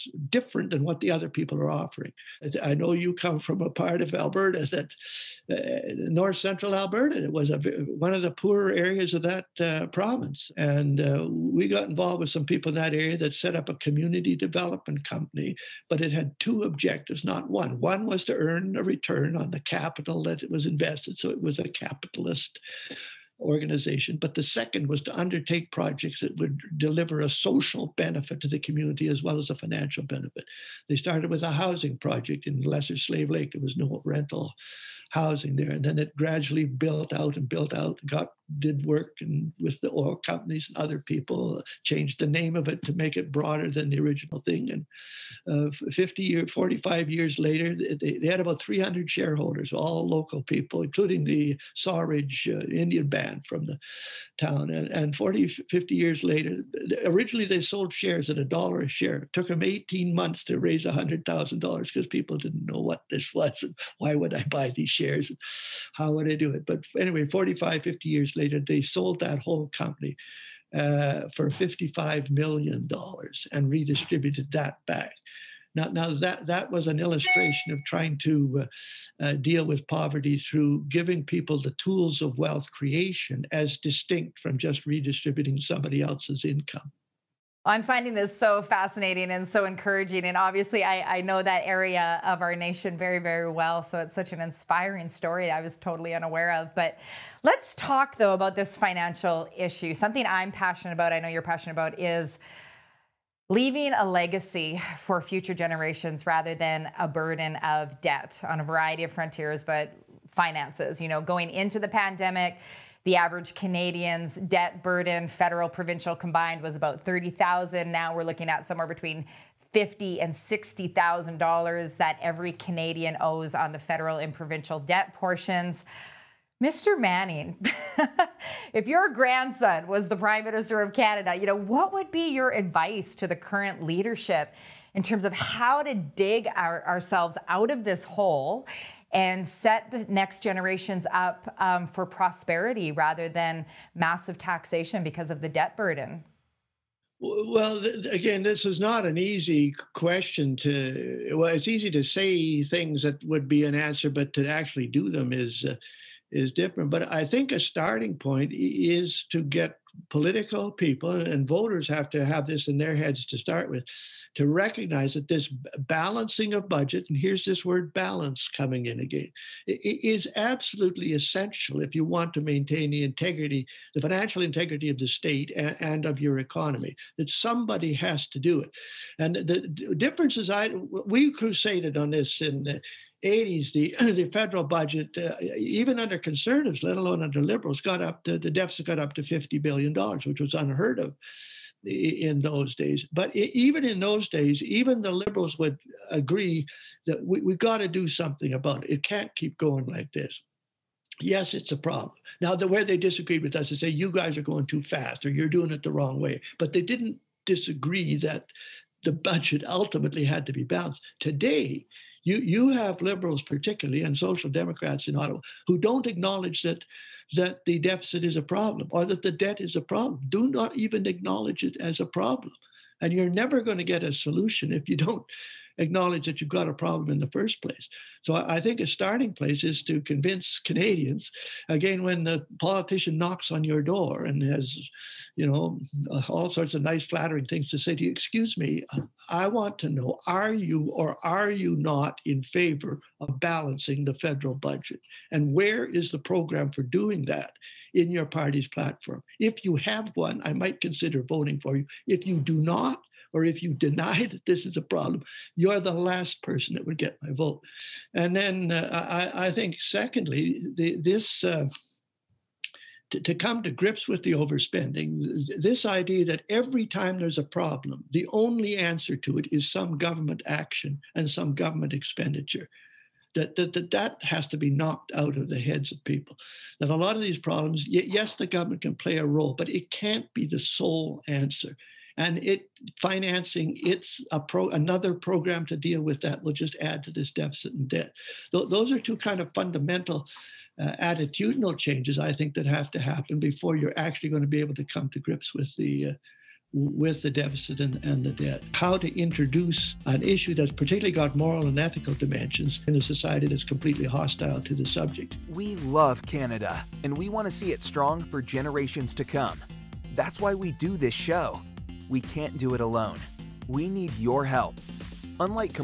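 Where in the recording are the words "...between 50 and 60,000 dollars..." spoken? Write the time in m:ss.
1:58.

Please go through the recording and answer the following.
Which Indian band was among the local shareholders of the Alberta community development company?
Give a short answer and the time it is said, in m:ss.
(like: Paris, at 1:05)
Sawridge, at 0:51.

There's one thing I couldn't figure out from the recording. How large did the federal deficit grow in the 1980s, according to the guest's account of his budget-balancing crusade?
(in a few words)
$50 billion.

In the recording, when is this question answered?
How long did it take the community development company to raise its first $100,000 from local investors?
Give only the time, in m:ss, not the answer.
0:59.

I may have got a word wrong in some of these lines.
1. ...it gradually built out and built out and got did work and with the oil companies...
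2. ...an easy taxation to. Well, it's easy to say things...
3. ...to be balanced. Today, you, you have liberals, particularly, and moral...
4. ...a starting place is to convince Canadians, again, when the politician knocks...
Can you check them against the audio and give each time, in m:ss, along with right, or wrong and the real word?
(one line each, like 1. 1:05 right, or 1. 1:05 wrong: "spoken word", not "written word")
1. 0:35 right
2. 2:29 wrong: "question", not "taxation"
3. 3:30 wrong: "social", not "moral"
4. 3:48 right.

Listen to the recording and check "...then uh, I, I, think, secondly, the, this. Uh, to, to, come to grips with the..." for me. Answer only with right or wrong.
right.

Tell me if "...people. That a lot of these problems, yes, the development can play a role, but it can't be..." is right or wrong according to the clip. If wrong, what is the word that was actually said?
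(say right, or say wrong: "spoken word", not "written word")
wrong: "government", not "development".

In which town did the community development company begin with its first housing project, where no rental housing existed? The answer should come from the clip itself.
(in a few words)
Lesser Slave Lake.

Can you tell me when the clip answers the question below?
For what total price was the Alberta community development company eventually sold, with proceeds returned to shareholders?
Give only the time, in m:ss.
1:11.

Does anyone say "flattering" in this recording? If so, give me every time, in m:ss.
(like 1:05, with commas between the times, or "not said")
3:57.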